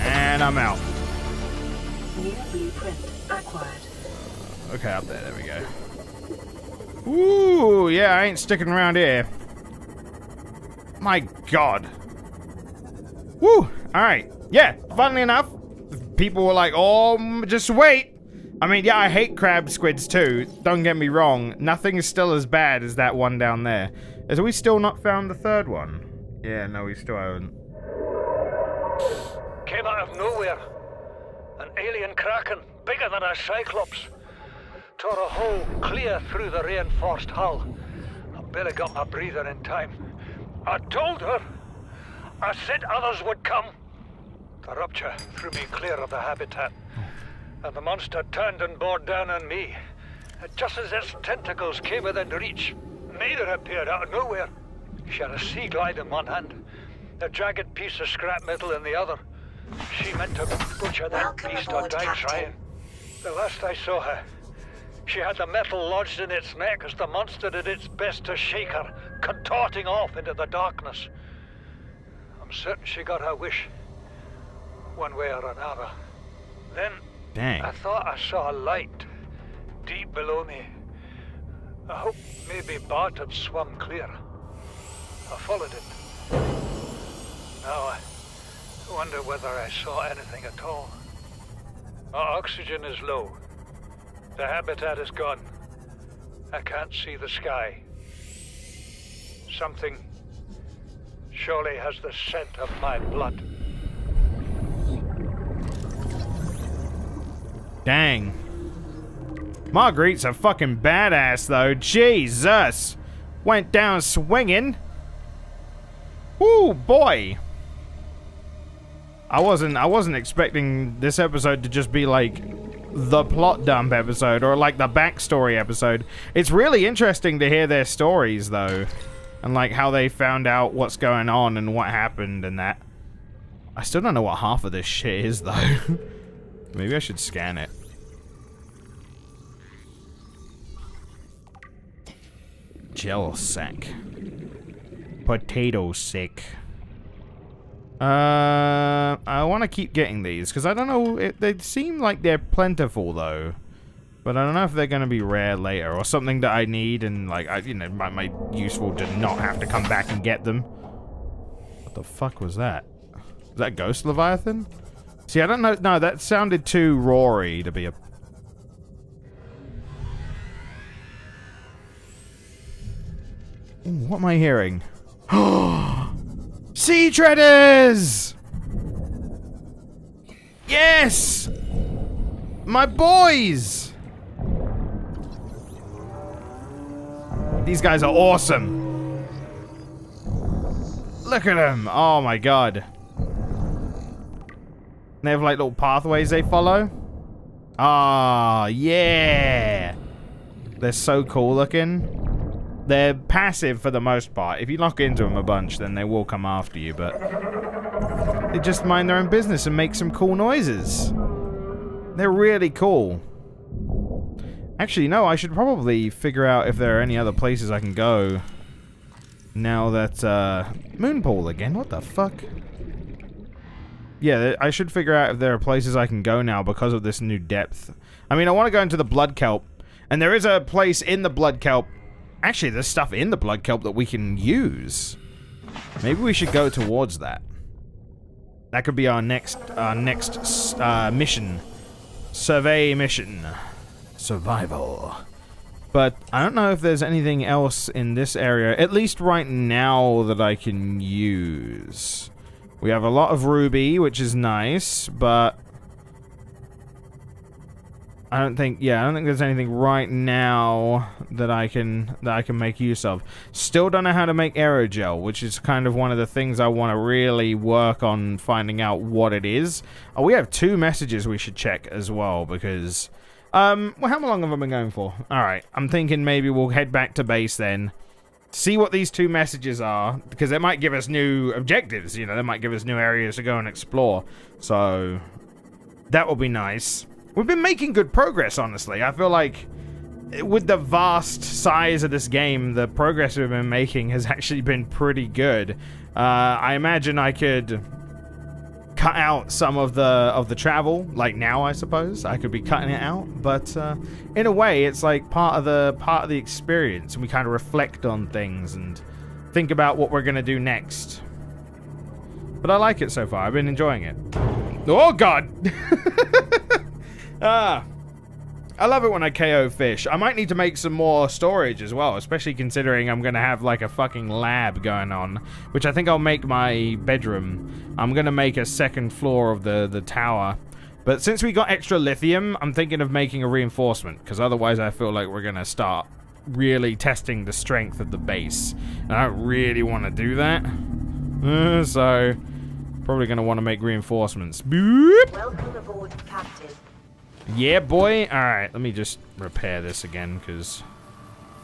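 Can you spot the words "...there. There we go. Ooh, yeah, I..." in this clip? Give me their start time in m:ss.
0:05.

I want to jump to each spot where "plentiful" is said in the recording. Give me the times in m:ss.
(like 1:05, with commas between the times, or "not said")
2:32.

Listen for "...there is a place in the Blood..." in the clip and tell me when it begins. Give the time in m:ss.
3:50.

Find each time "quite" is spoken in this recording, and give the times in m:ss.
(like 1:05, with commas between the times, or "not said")
not said.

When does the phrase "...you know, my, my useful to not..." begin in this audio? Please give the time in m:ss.
2:37.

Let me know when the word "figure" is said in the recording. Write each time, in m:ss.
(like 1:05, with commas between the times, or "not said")
3:36, 3:44.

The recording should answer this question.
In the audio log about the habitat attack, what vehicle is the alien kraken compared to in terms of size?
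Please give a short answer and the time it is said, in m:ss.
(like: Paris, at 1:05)
Cyclops, at 0:33.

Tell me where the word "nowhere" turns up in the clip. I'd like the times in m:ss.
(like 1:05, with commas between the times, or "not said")
0:30, 0:54.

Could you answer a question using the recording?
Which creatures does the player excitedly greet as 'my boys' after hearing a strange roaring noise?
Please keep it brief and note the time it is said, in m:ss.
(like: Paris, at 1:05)
Sea treaders, at 2:56.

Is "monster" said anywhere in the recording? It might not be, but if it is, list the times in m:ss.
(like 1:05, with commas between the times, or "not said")
0:47, 1:07.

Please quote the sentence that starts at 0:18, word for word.
I mean, yeah, I hate crab squids too.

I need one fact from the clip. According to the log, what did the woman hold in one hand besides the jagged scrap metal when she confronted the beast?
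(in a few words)
Sea glide.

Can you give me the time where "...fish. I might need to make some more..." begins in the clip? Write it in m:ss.
5:19.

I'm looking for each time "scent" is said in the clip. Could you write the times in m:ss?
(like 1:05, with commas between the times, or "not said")
1:42.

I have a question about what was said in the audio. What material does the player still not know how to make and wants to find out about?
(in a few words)
Aerogel.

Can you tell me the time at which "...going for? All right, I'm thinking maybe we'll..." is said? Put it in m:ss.
4:34.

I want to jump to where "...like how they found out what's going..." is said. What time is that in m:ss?
2:09.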